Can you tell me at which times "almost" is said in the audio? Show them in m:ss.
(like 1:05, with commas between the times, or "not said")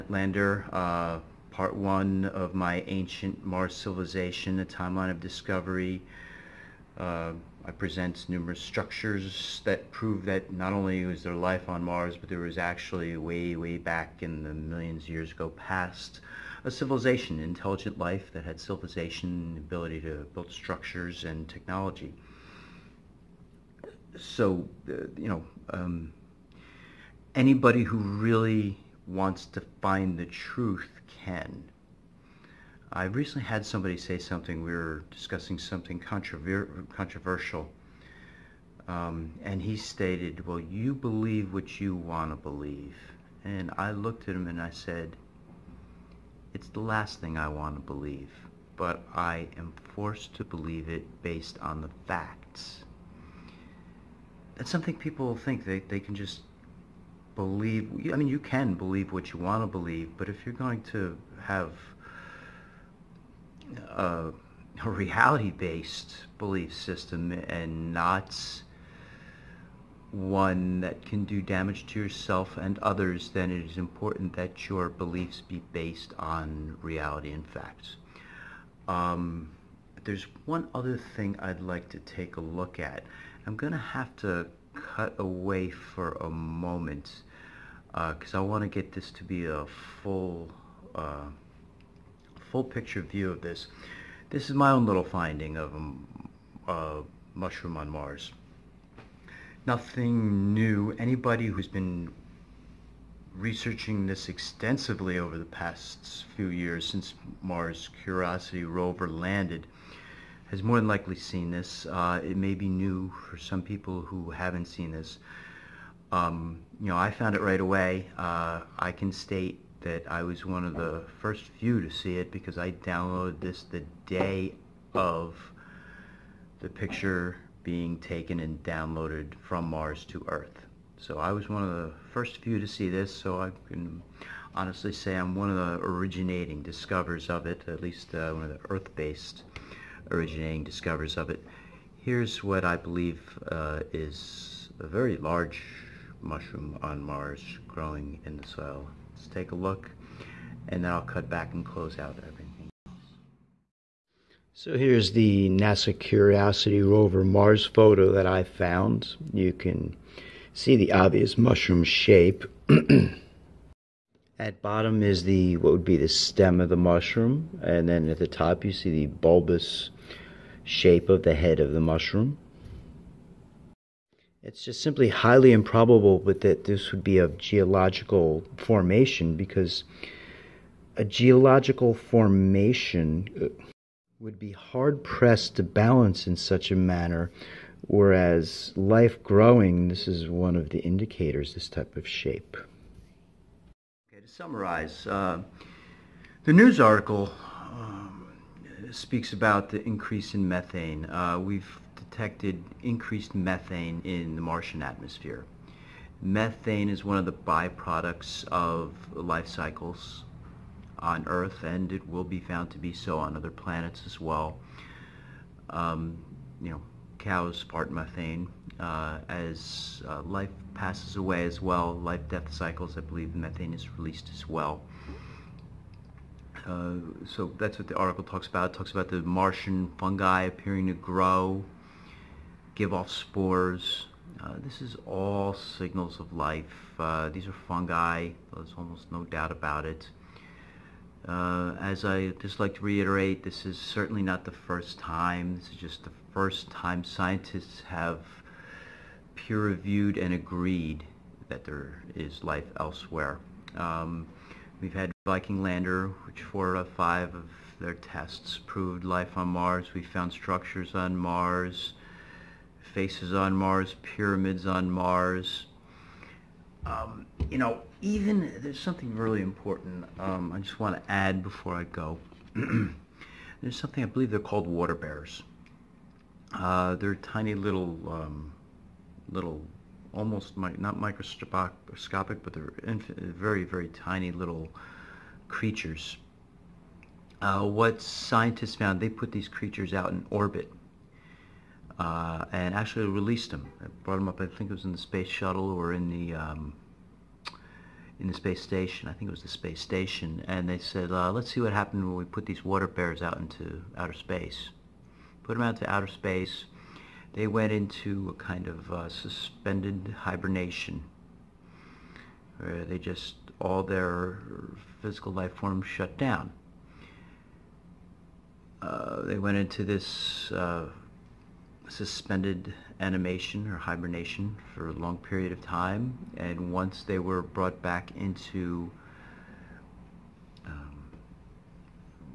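3:58, 4:40.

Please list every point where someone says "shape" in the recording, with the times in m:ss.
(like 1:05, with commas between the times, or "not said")
2:41, 2:50, 3:12.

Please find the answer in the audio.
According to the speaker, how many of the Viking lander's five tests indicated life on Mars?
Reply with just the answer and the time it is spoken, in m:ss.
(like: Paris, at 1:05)
4, at 4:16.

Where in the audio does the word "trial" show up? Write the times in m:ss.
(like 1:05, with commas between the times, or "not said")
not said.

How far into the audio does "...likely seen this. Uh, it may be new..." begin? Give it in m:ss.
1:50.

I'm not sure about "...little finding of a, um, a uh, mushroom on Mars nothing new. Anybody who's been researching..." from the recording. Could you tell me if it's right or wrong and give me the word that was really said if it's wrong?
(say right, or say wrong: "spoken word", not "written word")
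right.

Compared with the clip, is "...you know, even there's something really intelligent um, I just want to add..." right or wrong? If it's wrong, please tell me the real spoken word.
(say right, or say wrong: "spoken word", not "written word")
wrong: "important", not "intelligent".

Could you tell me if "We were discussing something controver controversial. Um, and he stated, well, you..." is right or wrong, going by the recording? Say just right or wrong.
right.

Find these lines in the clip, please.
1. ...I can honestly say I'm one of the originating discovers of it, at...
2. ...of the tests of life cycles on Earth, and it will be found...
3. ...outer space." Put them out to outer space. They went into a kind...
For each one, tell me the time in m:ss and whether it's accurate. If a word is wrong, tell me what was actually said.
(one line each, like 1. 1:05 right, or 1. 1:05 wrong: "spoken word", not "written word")
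1. 2:13 right
2. 3:27 wrong: "byproducts", not "tests"
3. 5:03 right.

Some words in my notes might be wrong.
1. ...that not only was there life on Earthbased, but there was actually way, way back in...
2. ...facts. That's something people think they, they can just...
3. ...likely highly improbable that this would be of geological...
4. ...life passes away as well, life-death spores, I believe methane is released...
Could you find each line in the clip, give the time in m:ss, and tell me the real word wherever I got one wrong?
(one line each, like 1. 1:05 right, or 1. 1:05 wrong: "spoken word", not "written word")
1. 0:10 wrong: "Mars", not "Earthbased"
2. 0:52 right
3. 2:54 wrong: "simply", not "likely"
4. 3:40 wrong: "cycles", not "spores".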